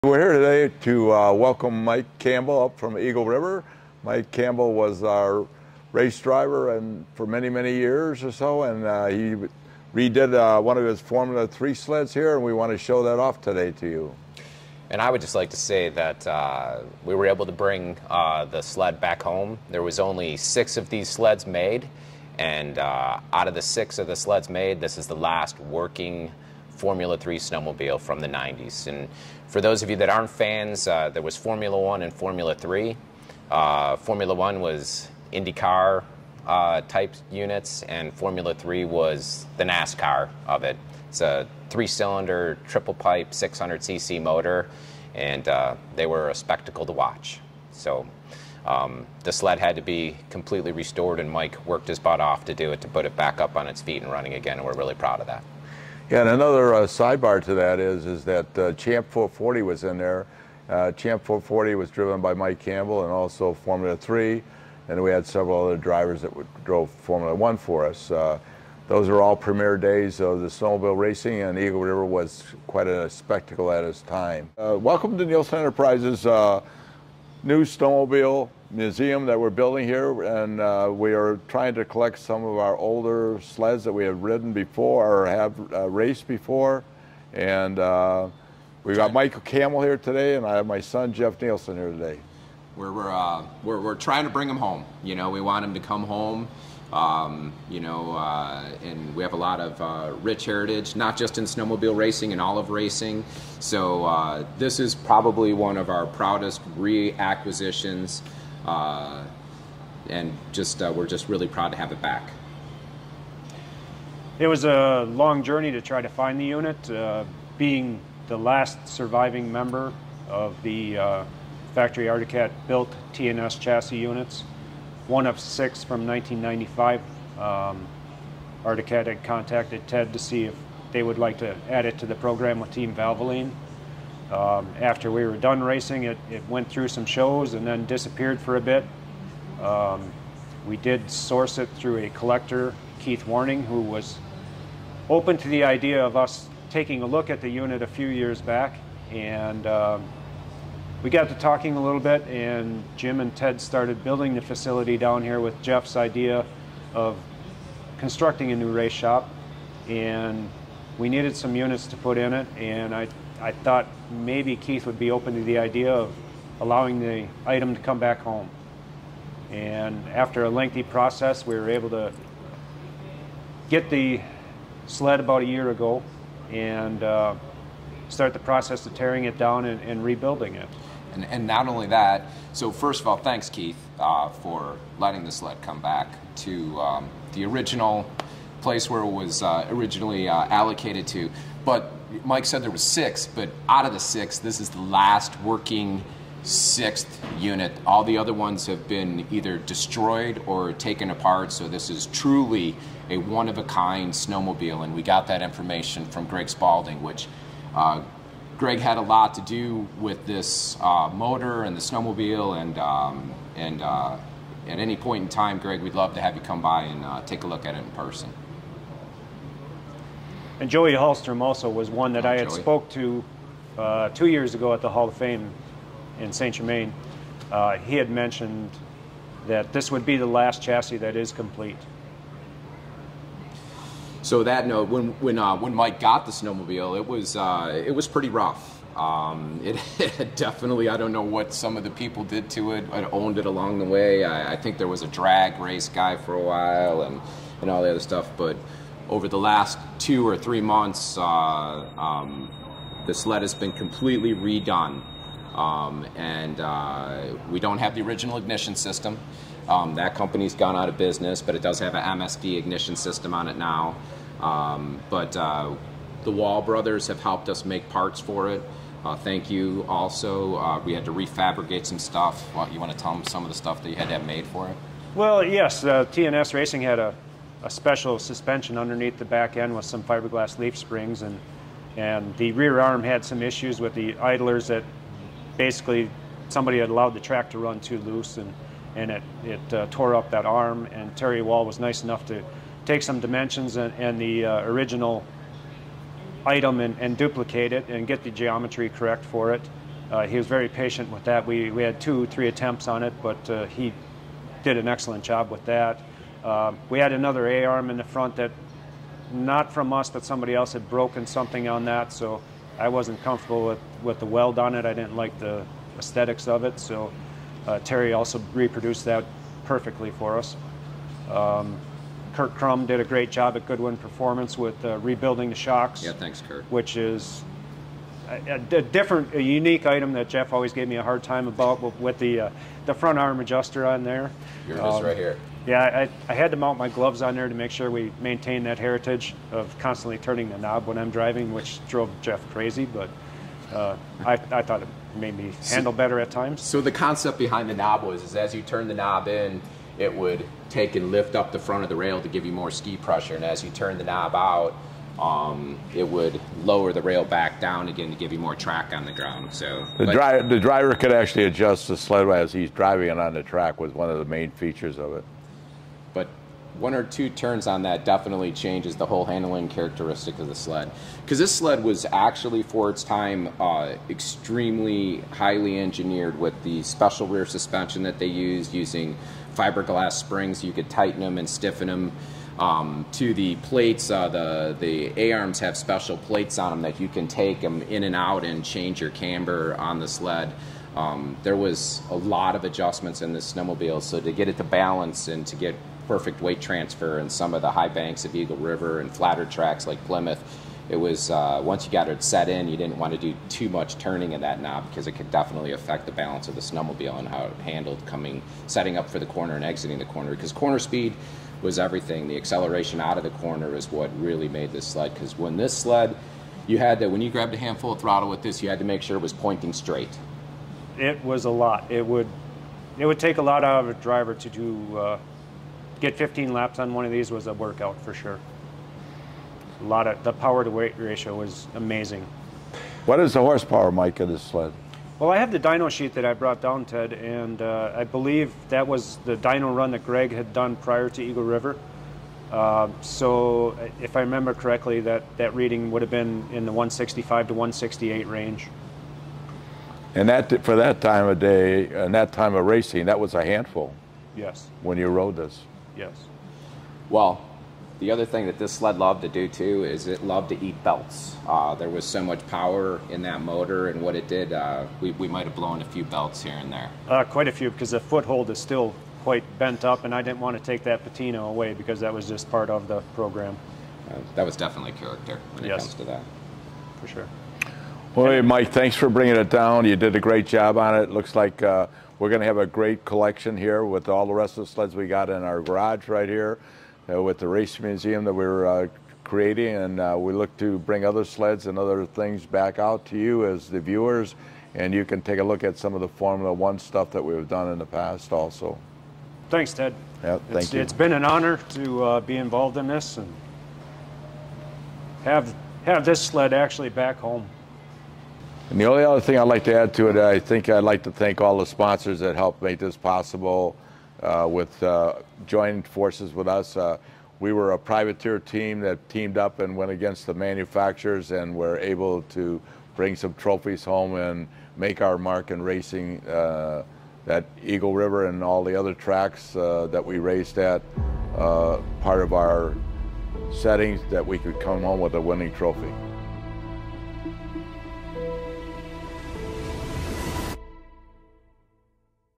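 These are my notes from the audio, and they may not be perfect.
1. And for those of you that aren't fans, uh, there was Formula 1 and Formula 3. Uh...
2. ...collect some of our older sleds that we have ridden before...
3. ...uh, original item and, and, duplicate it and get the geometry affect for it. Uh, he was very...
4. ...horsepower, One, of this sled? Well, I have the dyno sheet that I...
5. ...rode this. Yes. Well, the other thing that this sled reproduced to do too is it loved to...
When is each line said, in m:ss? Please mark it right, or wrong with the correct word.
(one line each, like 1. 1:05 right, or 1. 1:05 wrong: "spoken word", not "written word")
1. 0:28 right
2. 1:21 right
3. 4:54 wrong: "correct", not "affect"
4. 7:13 wrong: "Mike", not "One"
5. 7:35 wrong: "loved", not "reproduced".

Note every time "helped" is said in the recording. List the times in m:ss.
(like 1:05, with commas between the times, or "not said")
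4:27, 8:32.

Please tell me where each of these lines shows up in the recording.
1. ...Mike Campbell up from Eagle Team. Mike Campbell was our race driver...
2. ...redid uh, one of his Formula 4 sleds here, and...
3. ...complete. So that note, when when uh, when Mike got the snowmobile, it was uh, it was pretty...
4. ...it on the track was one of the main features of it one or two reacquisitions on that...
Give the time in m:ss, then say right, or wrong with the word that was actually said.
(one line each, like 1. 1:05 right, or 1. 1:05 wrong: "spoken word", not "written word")
1. 0:01 wrong: "River", not "Team"
2. 0:09 wrong: "3", not "4"
3. 3:51 right
4. 6:03 wrong: "turns", not "reacquisitions".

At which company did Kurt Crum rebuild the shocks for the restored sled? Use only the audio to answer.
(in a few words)
Goodwin Performance.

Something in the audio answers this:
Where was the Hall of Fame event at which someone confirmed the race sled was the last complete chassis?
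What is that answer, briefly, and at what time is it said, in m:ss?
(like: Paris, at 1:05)
Saint Germain, at 3:46.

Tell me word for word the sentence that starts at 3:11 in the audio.
But Mike said there was six, but out of the six, this is the last working sixth unit.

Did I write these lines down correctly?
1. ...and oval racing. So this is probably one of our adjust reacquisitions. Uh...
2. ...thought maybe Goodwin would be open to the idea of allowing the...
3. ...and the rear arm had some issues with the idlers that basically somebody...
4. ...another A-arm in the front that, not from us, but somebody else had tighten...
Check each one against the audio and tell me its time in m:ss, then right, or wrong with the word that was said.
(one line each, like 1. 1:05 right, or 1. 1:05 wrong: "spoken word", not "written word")
1. 1:42 wrong: "proudest", not "adjust"
2. 2:43 wrong: "Keith", not "Goodwin"
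3. 4:41 right
4. 5:07 wrong: "broken", not "tighten".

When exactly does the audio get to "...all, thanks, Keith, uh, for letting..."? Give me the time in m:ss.
3:03.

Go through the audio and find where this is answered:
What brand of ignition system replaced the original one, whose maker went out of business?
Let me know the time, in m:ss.
4:22.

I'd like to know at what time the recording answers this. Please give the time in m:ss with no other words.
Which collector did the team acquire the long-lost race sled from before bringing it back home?
2:22.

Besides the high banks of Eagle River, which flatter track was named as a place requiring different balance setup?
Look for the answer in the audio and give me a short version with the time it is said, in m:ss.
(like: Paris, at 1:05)
Plymouth, at 6:40.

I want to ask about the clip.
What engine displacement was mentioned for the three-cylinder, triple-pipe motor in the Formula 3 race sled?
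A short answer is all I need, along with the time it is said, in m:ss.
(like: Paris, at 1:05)
600cc, at 0:43.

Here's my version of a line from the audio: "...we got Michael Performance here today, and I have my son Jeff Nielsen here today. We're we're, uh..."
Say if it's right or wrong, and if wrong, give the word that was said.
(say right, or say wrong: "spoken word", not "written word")
wrong: "Campbell", not "Performance".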